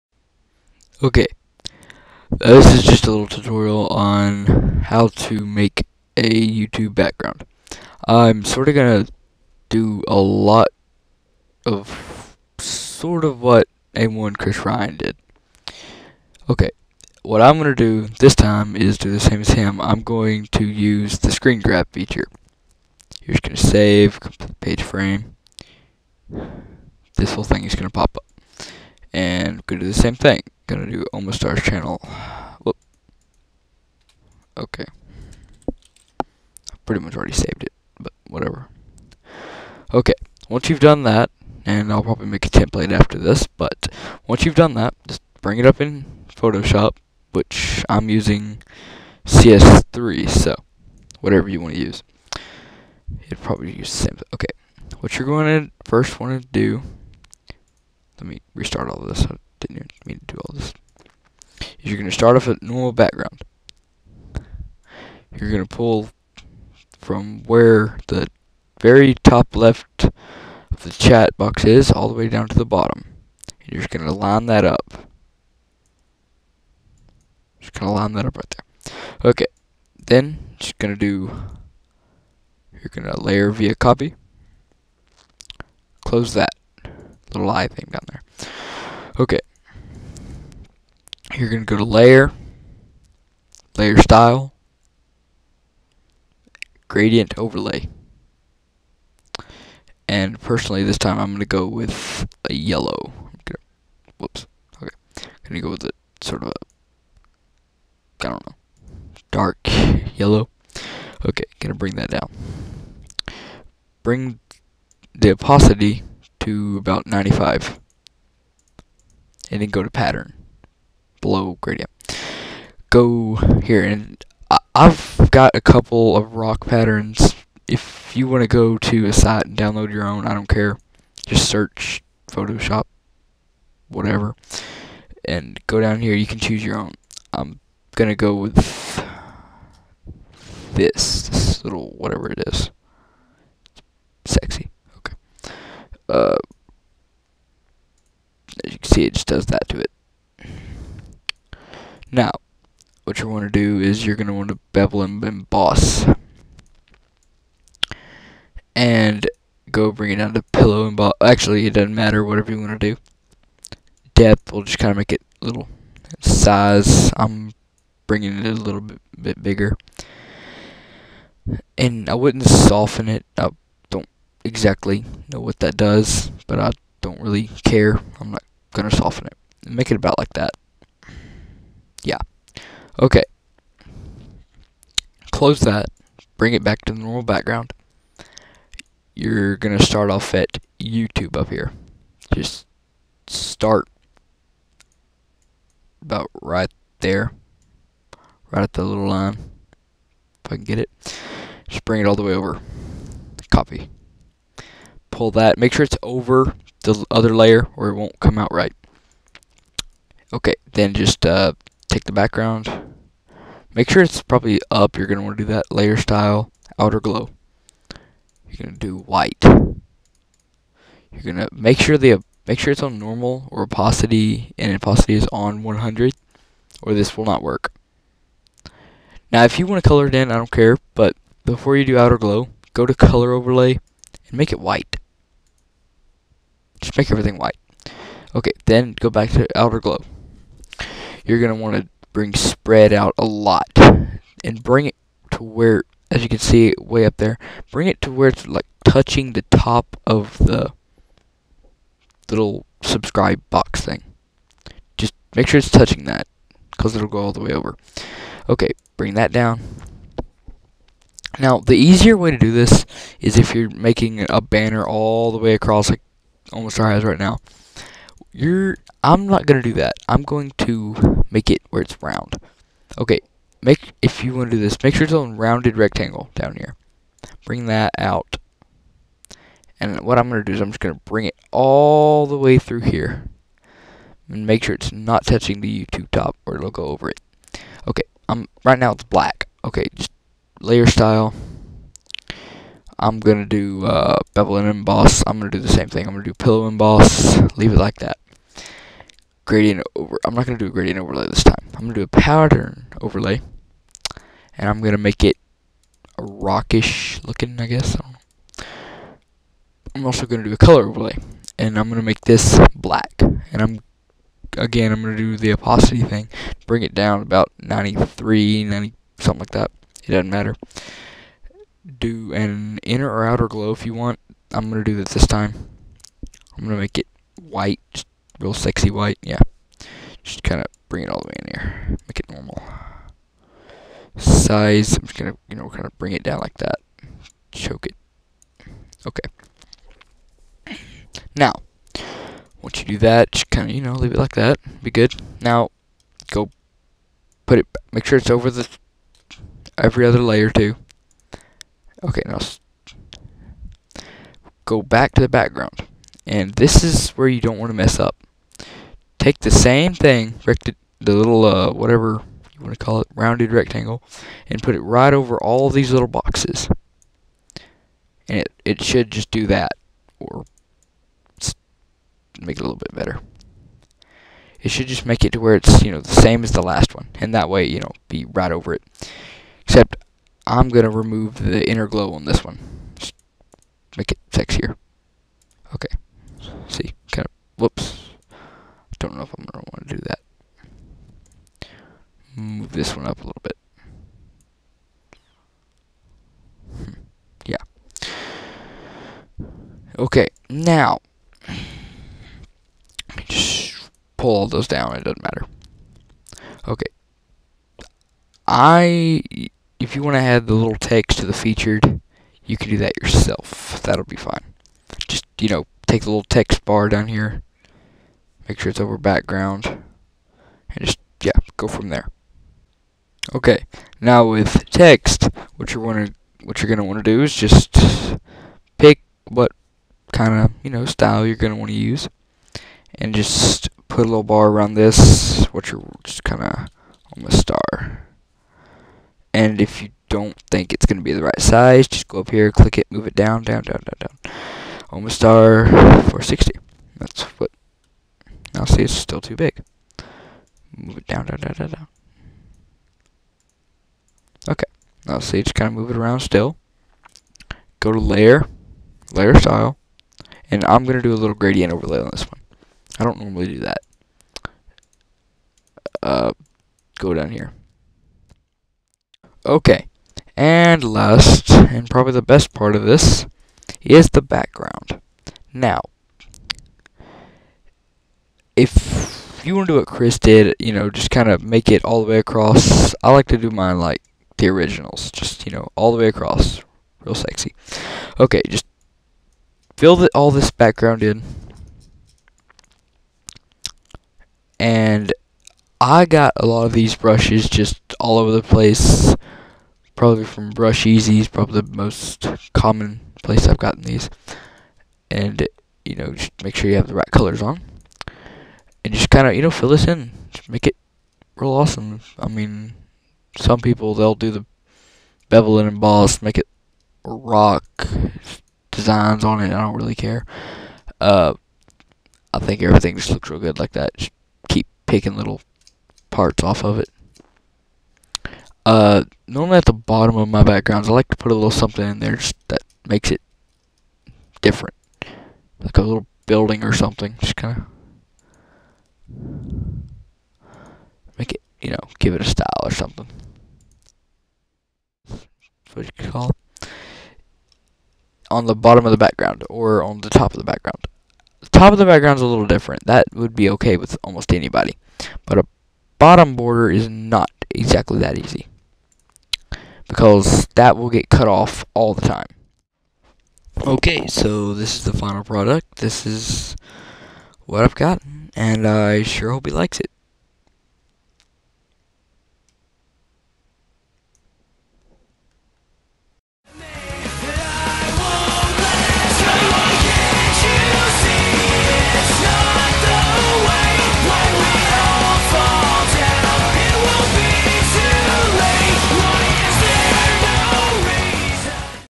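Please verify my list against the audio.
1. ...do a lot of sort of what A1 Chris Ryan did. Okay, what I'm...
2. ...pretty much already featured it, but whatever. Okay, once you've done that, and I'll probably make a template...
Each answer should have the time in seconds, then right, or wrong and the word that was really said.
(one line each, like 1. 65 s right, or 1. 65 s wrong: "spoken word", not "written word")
1. 9 s right
2. 36 s wrong: "saved", not "featured".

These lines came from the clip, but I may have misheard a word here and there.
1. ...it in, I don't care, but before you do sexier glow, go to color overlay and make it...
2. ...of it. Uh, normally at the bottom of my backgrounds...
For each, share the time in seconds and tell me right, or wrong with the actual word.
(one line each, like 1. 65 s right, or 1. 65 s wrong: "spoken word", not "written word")
1. 230 s wrong: "outer", not "sexier"
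2. 526 s right.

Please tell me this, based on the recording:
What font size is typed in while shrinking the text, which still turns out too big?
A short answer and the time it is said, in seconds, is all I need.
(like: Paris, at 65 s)
460, at 445 s.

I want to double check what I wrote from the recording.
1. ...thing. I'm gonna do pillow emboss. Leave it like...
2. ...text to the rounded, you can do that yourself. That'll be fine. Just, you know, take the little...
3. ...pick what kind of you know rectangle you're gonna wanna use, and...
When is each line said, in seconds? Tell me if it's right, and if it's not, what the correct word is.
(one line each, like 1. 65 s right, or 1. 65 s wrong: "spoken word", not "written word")
1. 295 s right
2. 410 s wrong: "featured", not "rounded"
3. 428 s wrong: "style", not "rectangle".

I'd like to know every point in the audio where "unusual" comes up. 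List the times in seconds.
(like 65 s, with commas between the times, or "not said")
not said.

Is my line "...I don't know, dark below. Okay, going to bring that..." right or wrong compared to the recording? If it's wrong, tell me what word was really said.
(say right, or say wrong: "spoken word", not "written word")
wrong: "yellow", not "below".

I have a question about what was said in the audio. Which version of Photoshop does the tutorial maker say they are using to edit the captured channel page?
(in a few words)
CS3.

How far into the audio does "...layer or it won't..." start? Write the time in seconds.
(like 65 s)
207 s.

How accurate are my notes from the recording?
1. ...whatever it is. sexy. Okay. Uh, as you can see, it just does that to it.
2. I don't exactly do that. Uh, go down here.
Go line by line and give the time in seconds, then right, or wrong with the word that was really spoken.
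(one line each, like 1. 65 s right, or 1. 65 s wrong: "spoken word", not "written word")
1. 141 s right
2. 462 s wrong: "normally", not "exactly".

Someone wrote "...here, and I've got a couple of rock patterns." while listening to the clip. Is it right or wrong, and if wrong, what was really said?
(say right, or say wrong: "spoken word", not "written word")
right.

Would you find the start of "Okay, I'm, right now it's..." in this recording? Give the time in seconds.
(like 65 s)
287 s.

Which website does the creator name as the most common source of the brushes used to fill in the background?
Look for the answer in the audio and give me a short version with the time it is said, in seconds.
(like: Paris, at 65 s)
Brusheezy's, at 500 s.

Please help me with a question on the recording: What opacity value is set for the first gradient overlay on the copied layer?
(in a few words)
95.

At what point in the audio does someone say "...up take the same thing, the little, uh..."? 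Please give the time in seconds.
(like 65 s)
357 s.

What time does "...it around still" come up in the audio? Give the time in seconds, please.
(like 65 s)
455 s.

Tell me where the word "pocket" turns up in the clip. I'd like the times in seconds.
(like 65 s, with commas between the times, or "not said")
not said.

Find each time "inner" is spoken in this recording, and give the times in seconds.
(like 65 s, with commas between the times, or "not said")
322 s, 381 s.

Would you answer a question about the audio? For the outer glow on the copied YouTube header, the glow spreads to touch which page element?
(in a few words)
subscribe box.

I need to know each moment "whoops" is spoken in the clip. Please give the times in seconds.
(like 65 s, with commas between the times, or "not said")
32 s, 104 s, 387 s.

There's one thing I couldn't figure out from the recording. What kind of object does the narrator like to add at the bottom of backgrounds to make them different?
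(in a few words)
a little building.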